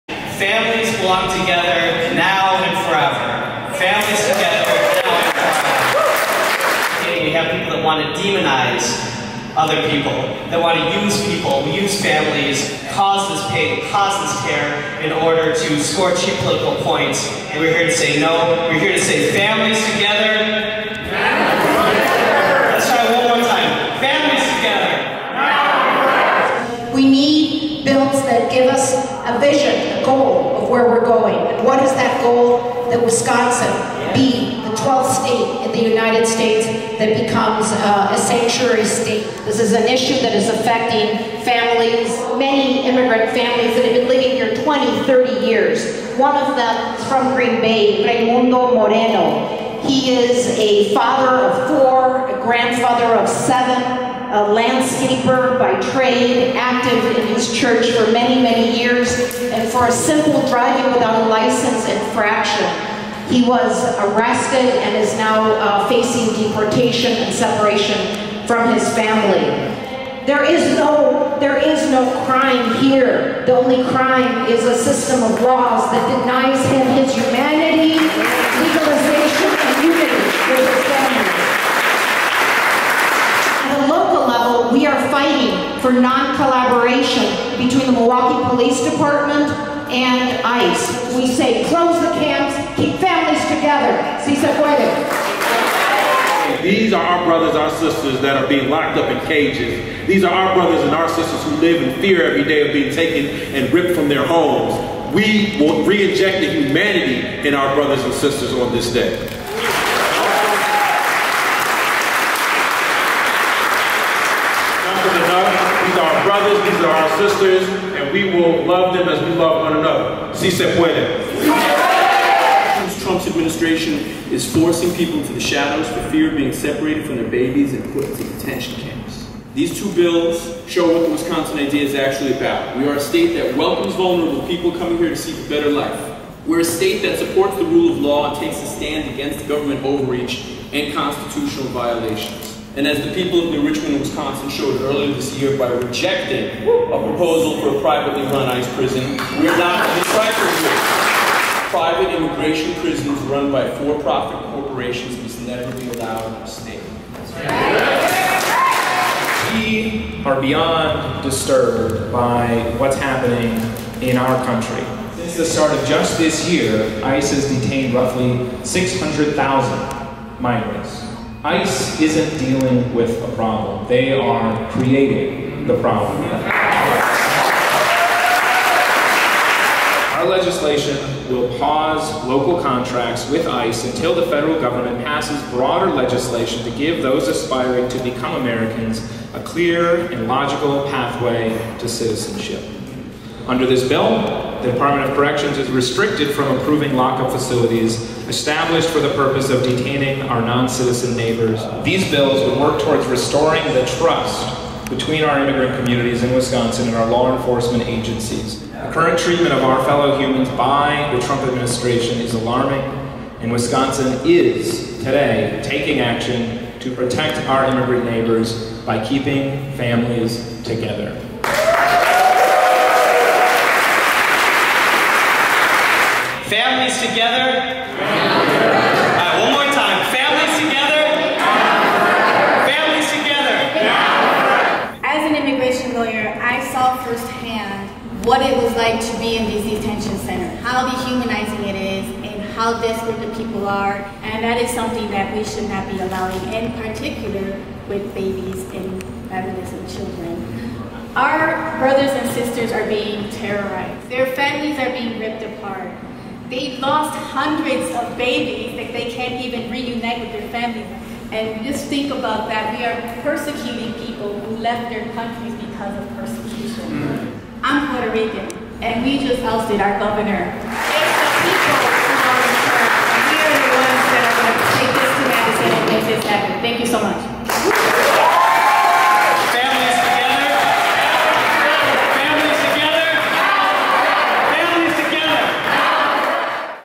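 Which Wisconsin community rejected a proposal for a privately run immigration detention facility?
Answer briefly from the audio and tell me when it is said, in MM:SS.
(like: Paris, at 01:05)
New Richmond, at 02:23.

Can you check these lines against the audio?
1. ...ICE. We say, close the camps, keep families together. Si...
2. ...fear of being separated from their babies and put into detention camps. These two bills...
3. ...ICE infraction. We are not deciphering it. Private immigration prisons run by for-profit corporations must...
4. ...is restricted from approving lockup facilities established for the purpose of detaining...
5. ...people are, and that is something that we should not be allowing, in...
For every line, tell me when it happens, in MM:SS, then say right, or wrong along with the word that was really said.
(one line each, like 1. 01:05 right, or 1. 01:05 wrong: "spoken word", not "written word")
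1. 01:30 right
2. 02:06 right
3. 02:28 wrong: "prison", not "infraction"
4. 03:15 right
5. 04:03 right.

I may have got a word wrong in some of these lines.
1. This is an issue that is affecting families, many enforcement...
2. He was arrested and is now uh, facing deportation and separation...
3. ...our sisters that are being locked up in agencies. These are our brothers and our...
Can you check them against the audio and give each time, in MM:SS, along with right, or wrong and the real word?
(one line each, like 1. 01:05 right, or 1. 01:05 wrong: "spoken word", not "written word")
1. 00:39 wrong: "immigrant", not "enforcement"
2. 01:03 right
3. 01:37 wrong: "cages", not "agencies".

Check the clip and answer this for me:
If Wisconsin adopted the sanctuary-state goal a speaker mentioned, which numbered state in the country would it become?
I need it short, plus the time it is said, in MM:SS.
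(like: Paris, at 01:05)
12th, at 00:34.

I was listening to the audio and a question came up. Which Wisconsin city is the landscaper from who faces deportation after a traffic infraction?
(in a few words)
Green Bay.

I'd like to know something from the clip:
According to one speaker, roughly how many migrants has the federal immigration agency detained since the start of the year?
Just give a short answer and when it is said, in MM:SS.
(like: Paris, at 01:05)
600,000, at 02:48.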